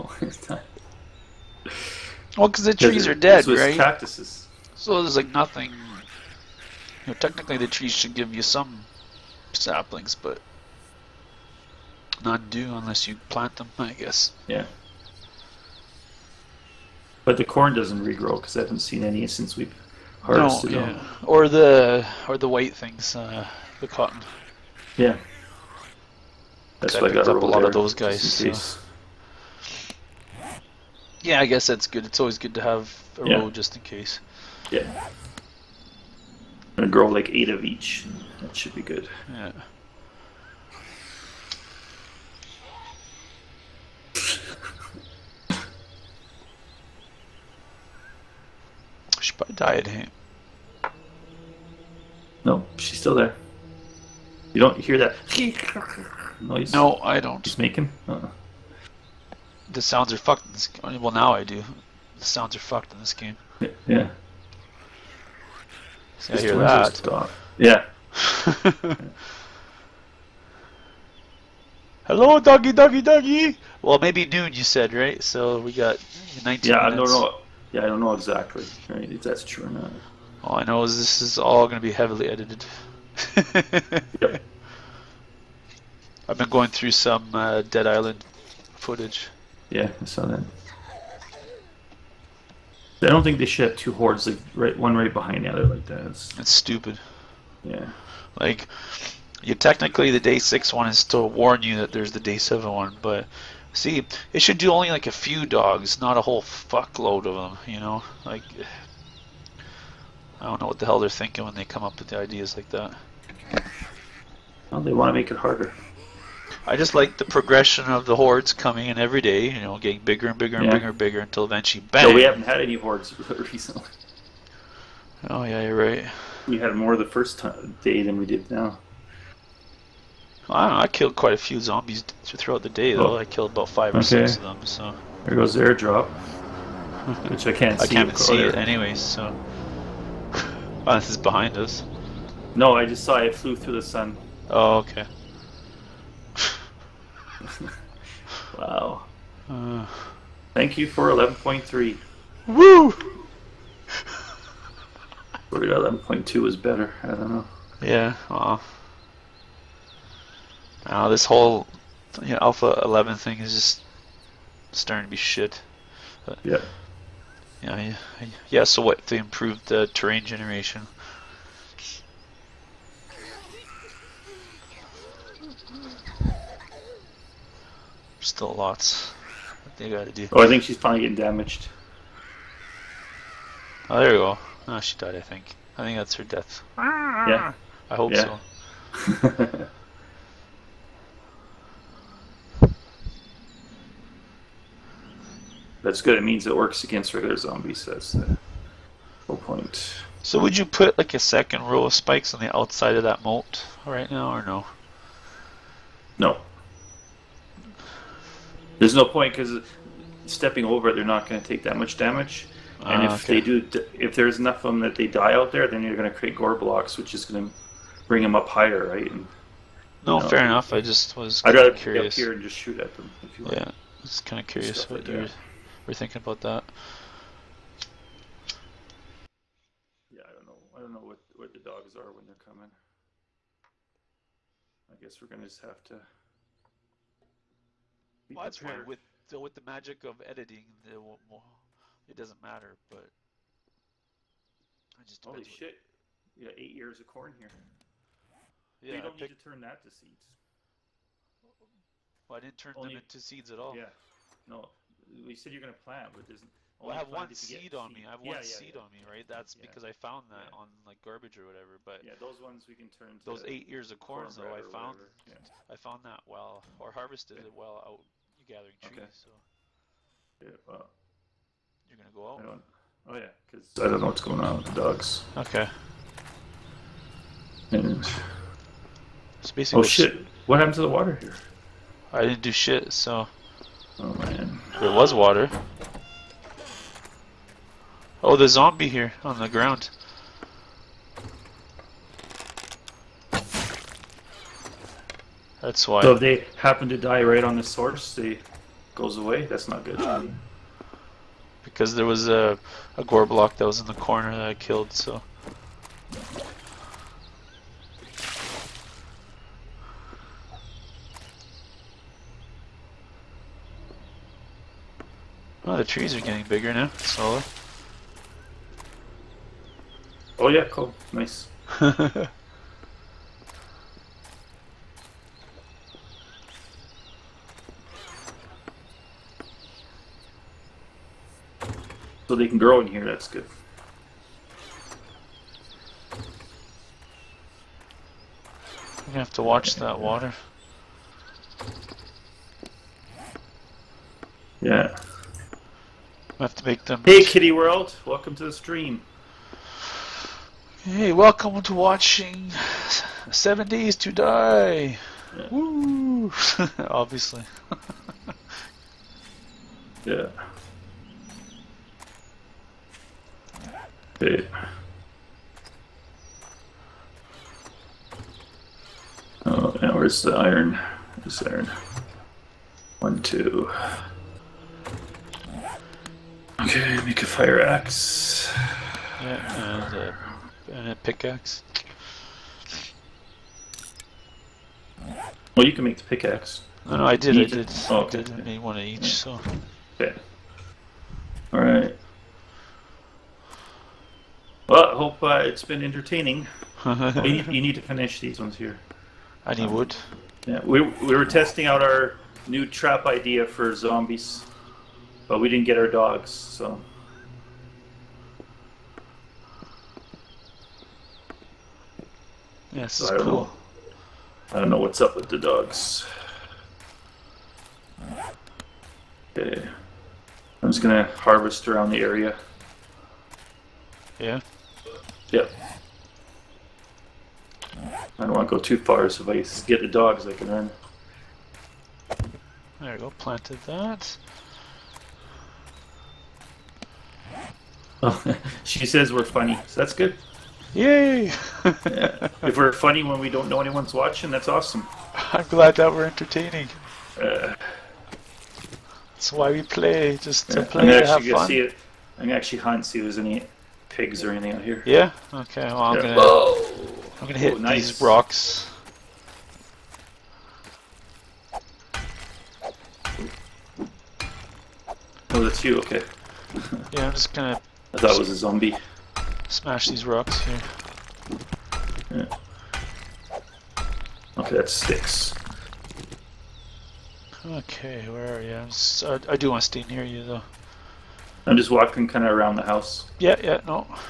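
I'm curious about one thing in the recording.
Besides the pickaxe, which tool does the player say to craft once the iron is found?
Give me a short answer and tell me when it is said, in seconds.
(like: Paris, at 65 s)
fire axe, at 377 s.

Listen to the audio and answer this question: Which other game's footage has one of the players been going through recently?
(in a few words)
Dead Island.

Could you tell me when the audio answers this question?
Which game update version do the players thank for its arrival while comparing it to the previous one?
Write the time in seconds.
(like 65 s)
151 s.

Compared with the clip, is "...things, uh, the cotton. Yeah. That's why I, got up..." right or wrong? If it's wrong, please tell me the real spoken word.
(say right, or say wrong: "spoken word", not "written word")
right.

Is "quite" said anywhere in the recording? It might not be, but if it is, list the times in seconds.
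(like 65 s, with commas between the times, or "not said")
131 s.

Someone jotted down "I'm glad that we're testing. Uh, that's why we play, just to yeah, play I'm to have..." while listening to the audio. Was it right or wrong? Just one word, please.
wrong.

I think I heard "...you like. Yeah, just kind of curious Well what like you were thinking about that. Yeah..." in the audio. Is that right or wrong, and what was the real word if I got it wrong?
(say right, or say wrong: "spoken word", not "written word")
wrong: "Stuff", not "Well".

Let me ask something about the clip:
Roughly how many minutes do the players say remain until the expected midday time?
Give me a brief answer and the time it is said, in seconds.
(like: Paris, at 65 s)
19, at 76 s.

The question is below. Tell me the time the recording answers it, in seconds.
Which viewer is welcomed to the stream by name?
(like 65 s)
347 s.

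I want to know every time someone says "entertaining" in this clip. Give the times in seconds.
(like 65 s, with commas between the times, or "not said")
395 s, 446 s.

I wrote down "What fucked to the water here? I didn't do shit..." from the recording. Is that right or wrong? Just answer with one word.
wrong.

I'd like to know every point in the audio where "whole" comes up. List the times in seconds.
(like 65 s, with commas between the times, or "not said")
106 s, 161 s, 199 s.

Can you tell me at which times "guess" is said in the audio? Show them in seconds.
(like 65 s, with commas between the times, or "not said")
13 s, 31 s, 234 s.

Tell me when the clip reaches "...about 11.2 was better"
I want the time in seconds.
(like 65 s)
155 s.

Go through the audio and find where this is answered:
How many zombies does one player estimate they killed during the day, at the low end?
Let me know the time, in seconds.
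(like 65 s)
133 s.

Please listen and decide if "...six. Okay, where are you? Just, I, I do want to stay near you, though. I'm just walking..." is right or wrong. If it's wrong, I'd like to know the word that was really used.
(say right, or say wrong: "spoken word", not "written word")
right.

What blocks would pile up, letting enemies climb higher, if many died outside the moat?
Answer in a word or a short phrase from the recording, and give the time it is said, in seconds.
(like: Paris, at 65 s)
gore blocks, at 216 s.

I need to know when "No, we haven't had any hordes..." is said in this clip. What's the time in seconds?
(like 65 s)
122 s.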